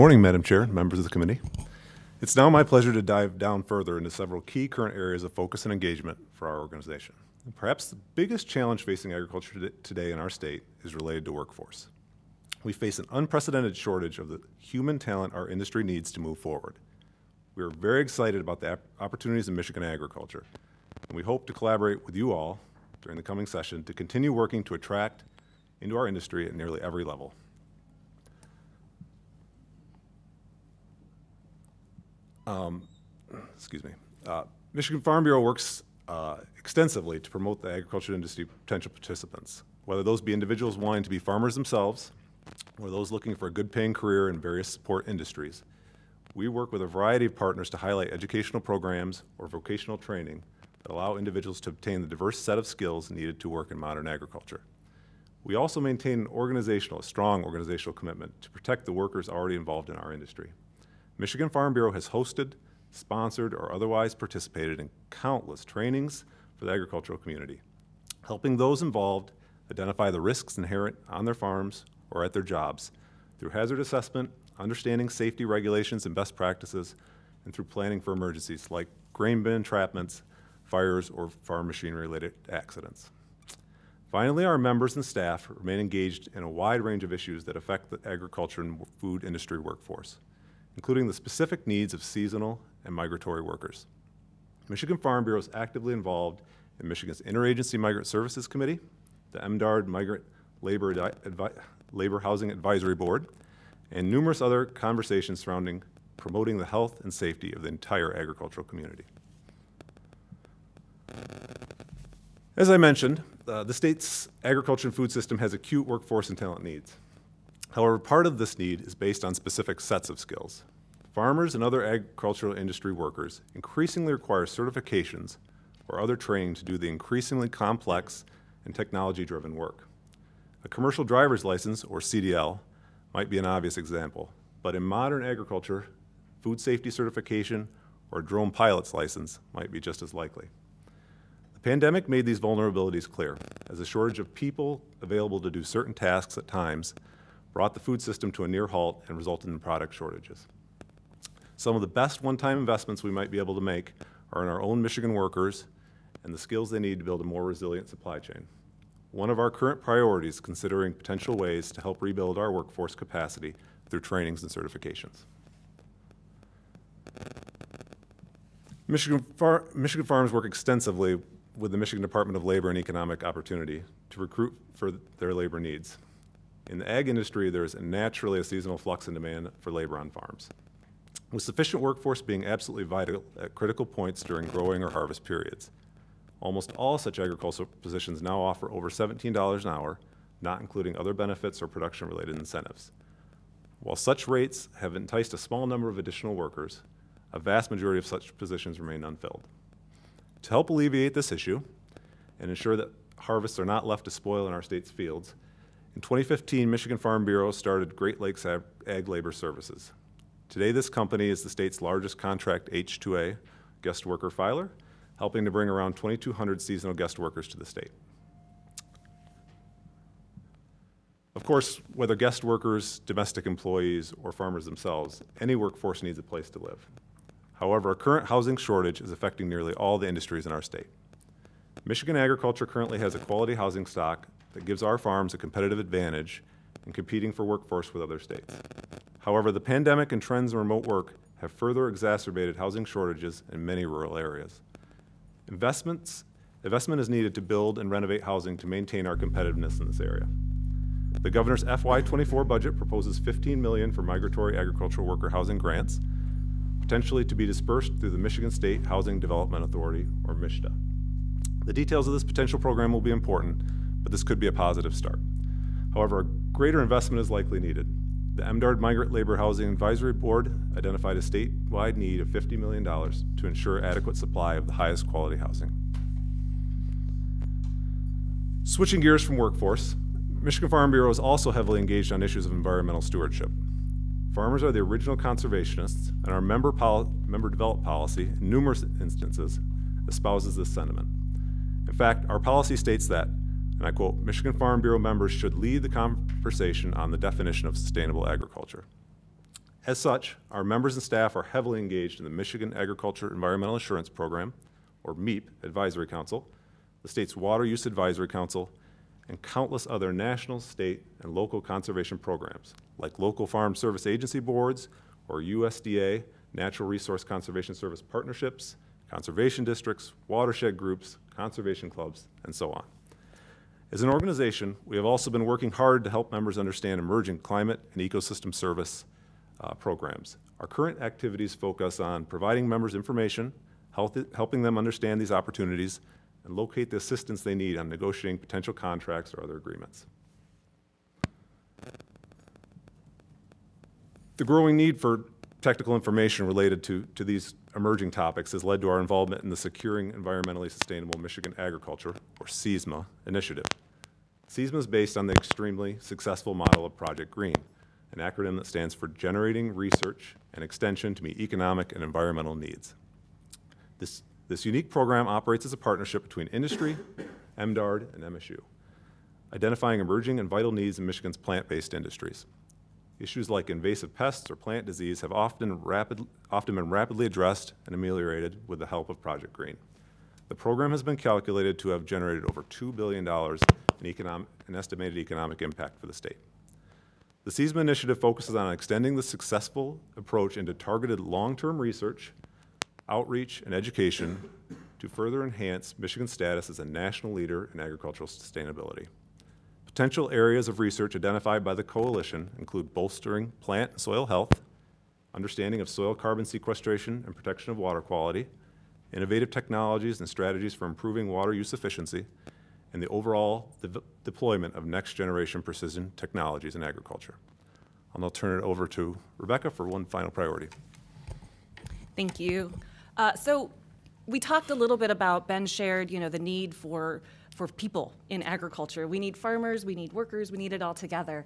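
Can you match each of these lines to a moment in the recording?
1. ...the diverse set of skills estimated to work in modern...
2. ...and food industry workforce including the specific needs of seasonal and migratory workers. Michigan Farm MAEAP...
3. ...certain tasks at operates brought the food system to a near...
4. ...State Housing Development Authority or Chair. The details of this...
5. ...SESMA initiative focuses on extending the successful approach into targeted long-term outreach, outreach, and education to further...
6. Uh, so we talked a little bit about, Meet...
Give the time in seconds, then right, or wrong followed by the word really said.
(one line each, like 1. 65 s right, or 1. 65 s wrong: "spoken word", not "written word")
1. 51 s wrong: "needed", not "estimated"
2. 88 s wrong: "Bureau", not "MAEAP"
3. 145 s wrong: "times", not "operates"
4. 258 s wrong: "MSHDA", not "Chair"
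5. 387 s wrong: "research", not "outreach"
6. 423 s wrong: "Ben", not "Meet".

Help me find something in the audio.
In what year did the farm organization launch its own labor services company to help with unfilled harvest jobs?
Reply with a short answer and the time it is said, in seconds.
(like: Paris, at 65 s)
2015, at 206 s.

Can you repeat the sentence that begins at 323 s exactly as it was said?
As an organization, we have also been working hard to help members understand emerging climate and ecosystem service uh, programs.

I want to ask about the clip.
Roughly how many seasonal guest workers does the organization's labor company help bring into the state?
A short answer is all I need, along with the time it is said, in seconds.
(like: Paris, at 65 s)
2,200, at 215 s.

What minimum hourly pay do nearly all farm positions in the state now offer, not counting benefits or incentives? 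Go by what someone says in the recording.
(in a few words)
$17.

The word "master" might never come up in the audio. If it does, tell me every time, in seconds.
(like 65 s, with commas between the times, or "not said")
not said.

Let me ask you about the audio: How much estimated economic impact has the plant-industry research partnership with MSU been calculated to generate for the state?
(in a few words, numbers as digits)
over $2 billion.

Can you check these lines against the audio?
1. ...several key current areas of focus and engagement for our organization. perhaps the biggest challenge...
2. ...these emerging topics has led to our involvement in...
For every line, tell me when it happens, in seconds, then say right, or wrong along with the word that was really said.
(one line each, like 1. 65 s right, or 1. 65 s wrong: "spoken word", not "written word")
1. 4 s right
2. 347 s right.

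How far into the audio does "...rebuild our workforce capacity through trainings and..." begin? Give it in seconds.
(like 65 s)
161 s.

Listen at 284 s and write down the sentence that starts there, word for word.
Farmers are the original conservationists, and our member, member developed policy, in numerous instances, espouses this sentiment.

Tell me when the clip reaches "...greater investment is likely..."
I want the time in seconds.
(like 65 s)
266 s.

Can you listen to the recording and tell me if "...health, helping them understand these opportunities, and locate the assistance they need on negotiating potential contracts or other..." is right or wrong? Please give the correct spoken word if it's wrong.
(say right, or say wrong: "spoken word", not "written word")
right.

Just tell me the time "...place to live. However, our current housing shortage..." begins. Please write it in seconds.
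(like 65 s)
226 s.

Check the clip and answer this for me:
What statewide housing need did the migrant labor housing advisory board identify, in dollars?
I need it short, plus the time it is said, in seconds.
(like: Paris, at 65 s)
$50 million, at 272 s.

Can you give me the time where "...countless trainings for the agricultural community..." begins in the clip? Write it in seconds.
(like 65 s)
65 s.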